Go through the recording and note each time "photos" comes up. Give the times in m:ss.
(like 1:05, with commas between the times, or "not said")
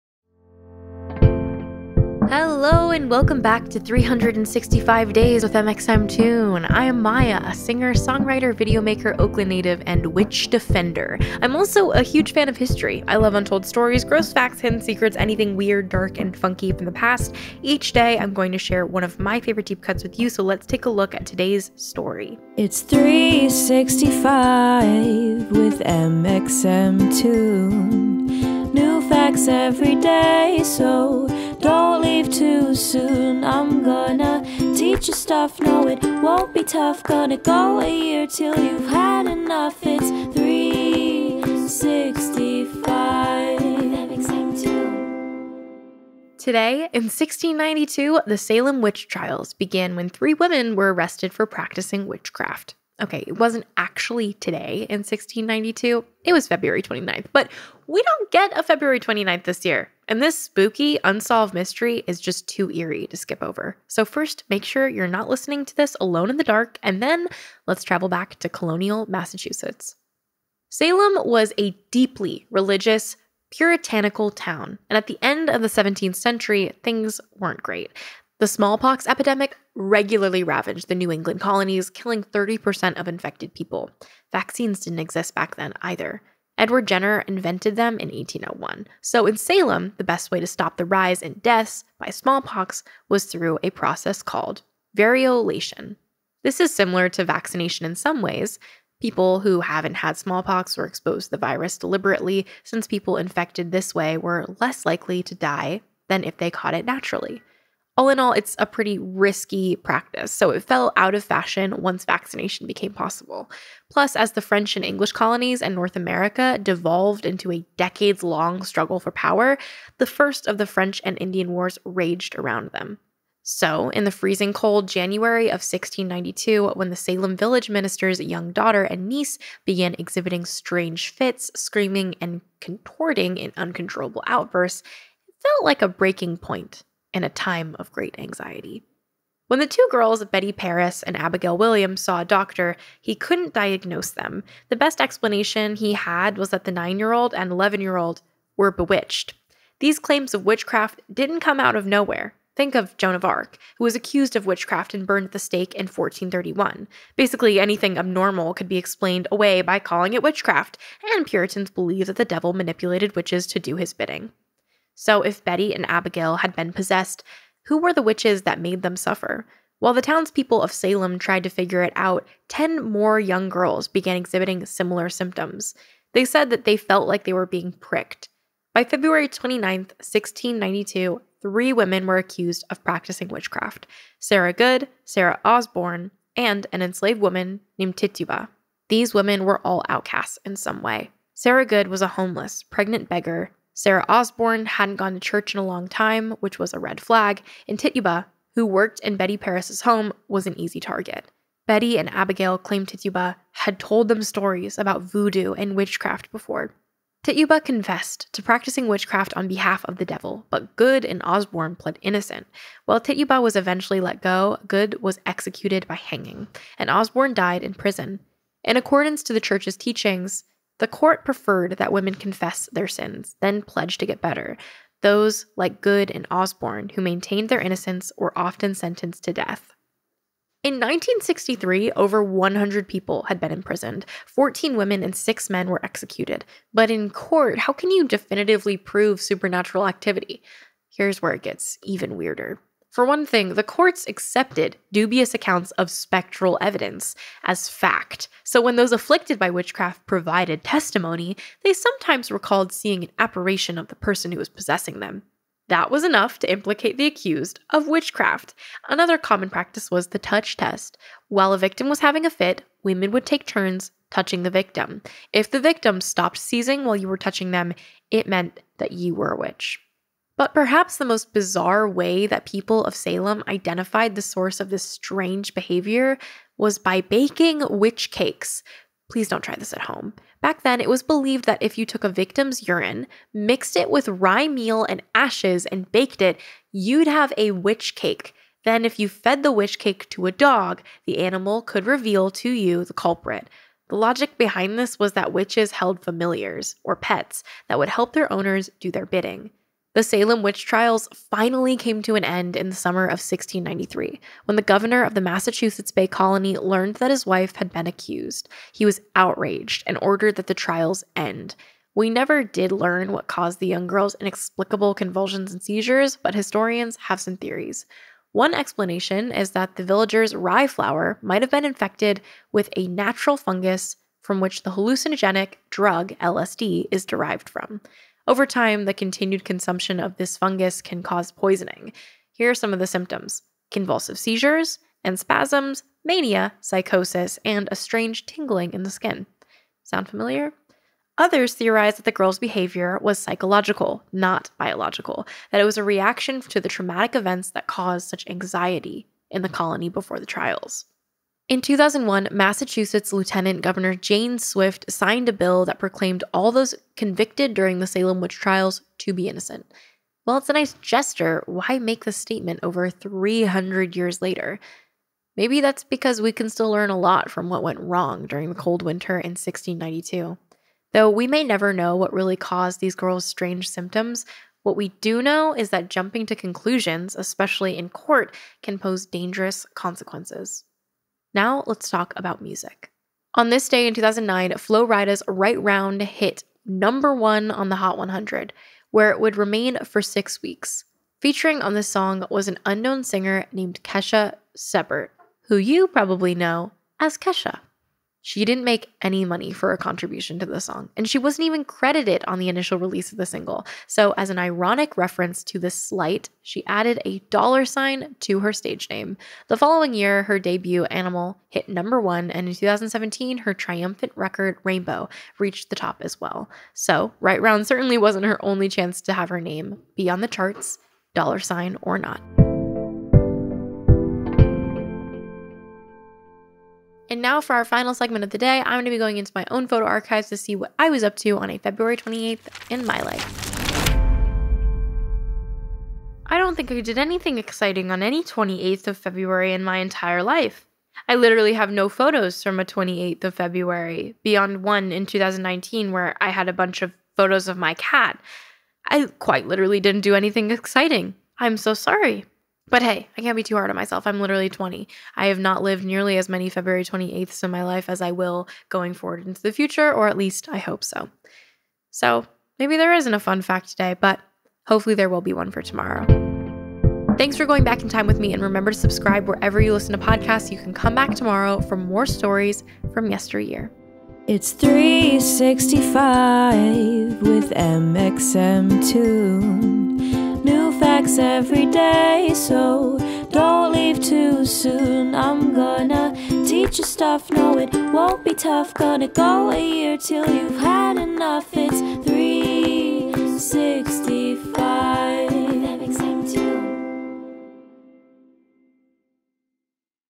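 7:09, 7:21, 7:27.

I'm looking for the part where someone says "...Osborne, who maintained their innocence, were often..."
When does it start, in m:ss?
3:46.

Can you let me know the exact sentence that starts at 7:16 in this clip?
I don't think I did anything exciting on any 28th of February in my entire life.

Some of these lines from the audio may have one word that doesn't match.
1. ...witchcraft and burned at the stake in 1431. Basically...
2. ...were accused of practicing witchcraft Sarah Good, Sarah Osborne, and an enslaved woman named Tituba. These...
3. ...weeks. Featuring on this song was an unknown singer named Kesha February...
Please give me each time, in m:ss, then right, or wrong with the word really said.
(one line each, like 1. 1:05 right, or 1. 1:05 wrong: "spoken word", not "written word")
1. 2:34 right
2. 3:02 right
3. 6:30 wrong: "Sebert", not "February".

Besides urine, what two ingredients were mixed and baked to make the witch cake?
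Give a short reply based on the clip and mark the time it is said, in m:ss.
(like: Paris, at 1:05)
rye meal and ashes, at 4:44.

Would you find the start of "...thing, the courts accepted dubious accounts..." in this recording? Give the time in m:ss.
4:03.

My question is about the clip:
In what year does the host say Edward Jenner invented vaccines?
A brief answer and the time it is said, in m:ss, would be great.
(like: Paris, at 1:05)
1801, at 1:28.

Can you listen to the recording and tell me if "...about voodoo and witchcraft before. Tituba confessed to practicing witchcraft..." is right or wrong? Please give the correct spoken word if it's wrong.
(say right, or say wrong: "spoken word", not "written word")
right.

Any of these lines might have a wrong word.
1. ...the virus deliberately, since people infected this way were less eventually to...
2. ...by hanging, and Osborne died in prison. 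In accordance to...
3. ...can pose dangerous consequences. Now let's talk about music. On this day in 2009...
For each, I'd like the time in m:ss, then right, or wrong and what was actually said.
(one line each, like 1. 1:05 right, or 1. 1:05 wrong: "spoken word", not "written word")
1. 1:41 wrong: "likely", not "eventually"
2. 3:35 right
3. 6:18 right.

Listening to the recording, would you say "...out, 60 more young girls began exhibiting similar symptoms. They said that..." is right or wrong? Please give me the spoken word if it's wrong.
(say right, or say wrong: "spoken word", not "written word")
wrong: "10", not "60".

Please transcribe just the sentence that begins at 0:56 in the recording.
It was February 29th, but we don't get a February 29th this year.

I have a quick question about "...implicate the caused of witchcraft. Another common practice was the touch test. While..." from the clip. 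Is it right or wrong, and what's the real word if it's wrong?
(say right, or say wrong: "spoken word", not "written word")
wrong: "accused", not "caused".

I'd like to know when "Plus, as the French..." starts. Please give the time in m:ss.
1:53.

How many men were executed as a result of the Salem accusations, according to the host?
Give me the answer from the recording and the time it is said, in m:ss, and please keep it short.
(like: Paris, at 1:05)
6, at 3:55.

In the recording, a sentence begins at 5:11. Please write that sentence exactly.
We never did learn what caused the young girl's inexplicable convulsions and seizures, but historians have some theories.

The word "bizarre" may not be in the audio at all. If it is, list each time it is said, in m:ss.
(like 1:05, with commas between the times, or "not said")
4:31.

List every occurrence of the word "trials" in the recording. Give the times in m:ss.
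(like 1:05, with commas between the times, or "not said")
0:49, 5:00, 5:10, 5:50, 5:58.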